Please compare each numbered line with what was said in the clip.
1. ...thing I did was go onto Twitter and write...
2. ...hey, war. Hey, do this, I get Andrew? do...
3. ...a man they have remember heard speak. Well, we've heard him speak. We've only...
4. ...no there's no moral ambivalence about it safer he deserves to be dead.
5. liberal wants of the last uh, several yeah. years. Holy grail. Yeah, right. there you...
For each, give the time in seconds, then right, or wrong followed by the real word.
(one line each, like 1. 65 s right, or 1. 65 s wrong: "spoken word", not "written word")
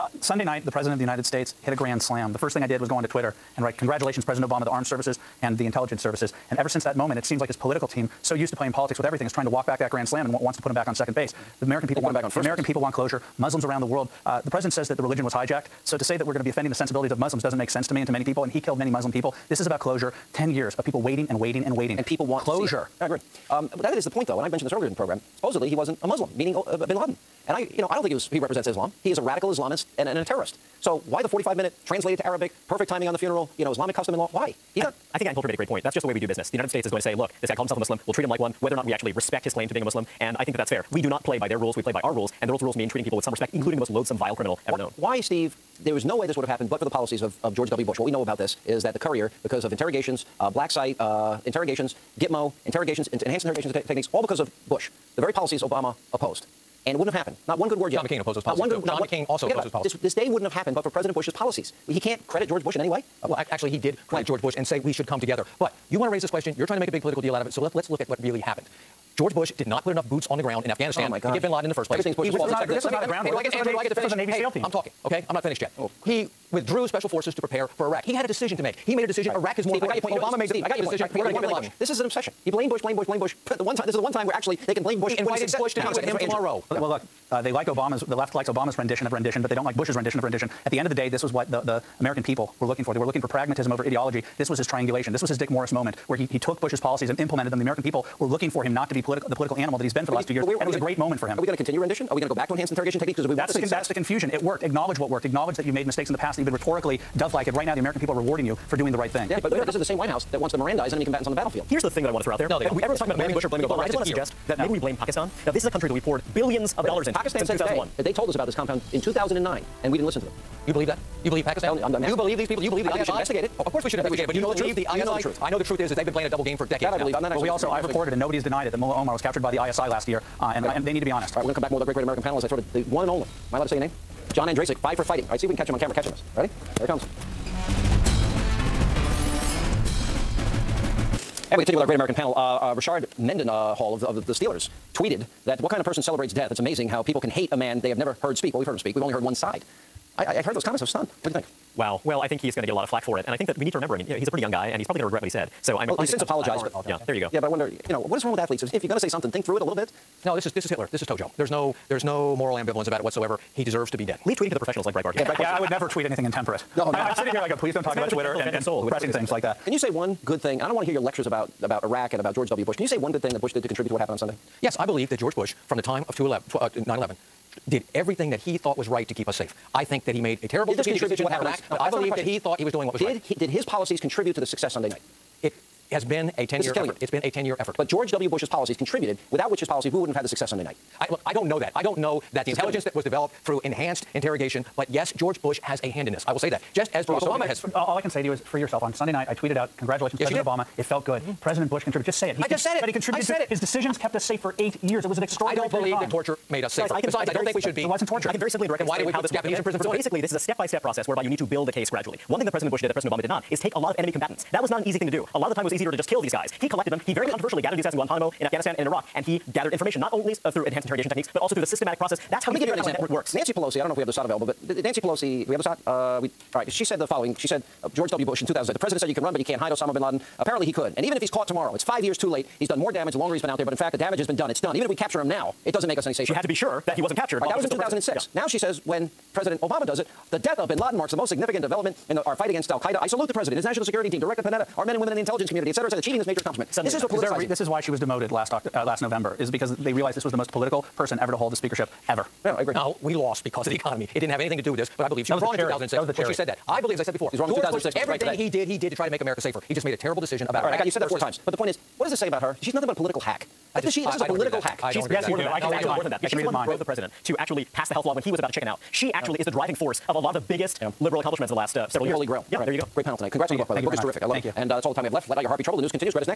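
1. 2 s right
2. 73 s right
3. 147 s wrong: "never", not "remember"
4. 161 s wrong: "whatsoever", not "safer"
5. 271 s wrong: "accomplishments", not "wants".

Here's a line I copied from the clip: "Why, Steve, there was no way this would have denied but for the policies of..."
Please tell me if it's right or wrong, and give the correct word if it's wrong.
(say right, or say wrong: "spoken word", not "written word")
wrong: "happened", not "denied".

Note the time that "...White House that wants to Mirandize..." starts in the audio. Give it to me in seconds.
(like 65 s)
109 s.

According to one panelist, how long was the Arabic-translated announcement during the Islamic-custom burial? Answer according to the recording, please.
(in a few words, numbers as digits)
45 minute.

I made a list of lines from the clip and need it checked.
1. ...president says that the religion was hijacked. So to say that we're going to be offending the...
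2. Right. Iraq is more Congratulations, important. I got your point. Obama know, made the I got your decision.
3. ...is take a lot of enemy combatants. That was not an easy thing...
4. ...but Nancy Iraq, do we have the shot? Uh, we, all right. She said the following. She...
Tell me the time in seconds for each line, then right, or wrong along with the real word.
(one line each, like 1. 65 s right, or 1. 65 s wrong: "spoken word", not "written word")
1. 14 s right
2. 79 s wrong: "Steve", not "Congratulations"
3. 213 s right
4. 224 s wrong: "Pelosi", not "Iraq".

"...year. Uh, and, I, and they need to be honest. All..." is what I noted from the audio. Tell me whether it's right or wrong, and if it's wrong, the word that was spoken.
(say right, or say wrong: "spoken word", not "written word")
right.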